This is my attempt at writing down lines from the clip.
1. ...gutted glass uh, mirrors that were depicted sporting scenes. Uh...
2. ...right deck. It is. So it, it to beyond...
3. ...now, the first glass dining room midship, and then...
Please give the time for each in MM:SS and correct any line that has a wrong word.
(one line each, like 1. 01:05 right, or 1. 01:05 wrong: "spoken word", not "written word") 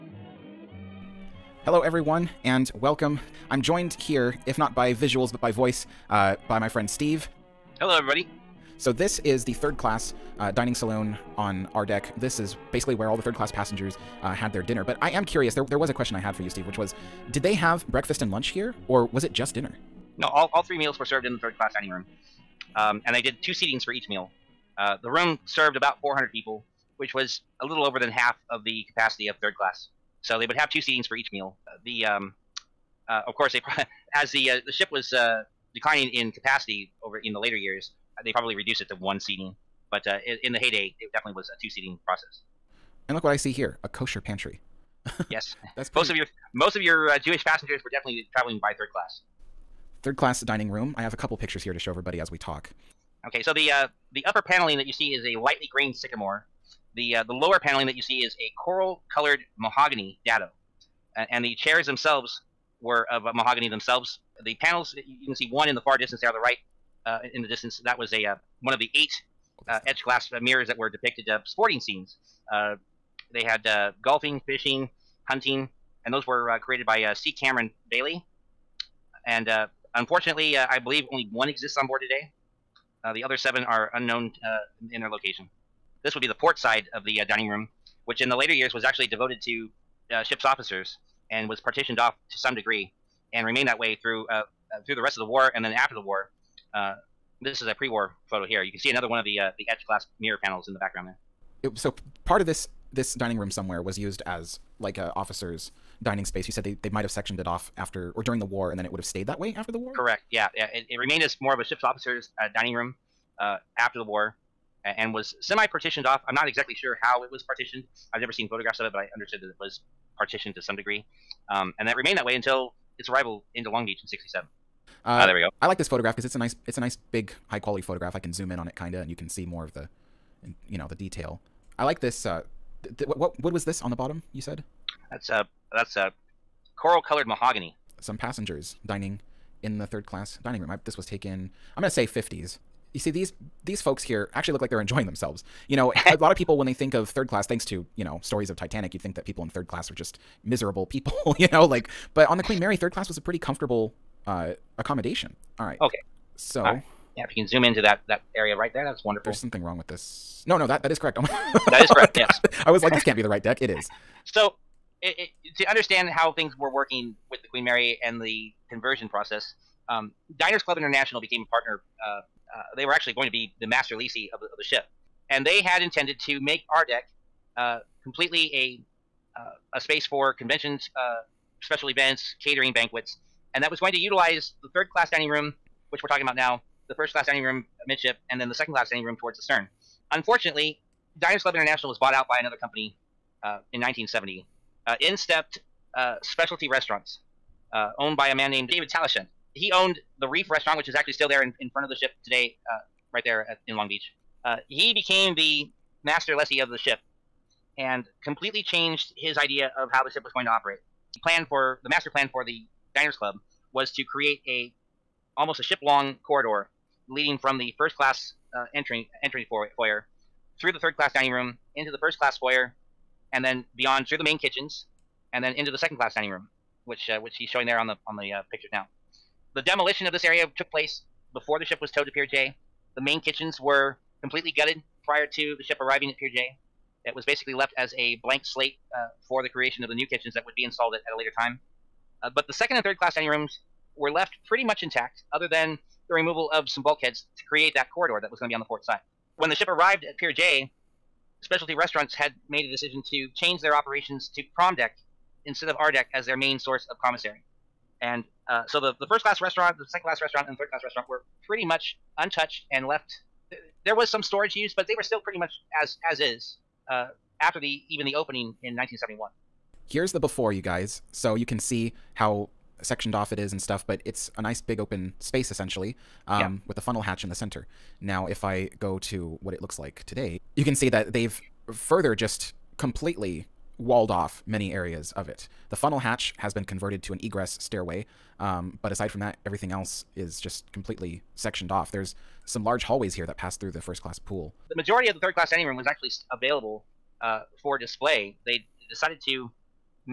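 1. 01:09 wrong: "etched", not "gutted"
2. 02:43 wrong: "understand", not "beyond"
3. 03:06 wrong: "class", not "glass".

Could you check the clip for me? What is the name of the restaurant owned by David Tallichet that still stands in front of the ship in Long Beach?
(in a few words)
The Reef.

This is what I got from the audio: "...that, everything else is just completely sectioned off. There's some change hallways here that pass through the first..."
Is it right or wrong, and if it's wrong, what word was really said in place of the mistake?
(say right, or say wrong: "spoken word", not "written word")
wrong: "large", not "change".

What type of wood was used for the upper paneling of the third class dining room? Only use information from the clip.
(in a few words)
Sycamore.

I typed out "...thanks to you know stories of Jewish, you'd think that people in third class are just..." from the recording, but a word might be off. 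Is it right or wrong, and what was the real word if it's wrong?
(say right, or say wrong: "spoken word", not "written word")
wrong: "Titanic", not "Jewish".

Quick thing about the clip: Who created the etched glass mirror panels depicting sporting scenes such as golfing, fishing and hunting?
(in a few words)
C. Cameron Bailey.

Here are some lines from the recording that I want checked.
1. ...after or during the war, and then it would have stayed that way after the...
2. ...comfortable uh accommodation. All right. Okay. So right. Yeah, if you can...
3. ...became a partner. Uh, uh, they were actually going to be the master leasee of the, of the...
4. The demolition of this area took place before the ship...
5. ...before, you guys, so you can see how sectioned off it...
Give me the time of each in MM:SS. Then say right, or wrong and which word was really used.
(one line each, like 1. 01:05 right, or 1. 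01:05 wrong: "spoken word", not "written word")
1. 01:47 right
2. 02:33 right
3. 02:51 right
4. 03:49 right
5. 04:30 right.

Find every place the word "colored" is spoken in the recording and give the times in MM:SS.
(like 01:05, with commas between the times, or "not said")
00:59, 02:16.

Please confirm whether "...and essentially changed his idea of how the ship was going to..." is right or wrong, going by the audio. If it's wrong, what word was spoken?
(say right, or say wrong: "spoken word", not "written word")
wrong: "completely", not "essentially".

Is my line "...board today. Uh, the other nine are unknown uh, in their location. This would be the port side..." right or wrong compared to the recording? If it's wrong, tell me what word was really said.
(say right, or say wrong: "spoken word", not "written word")
wrong: "seven", not "nine".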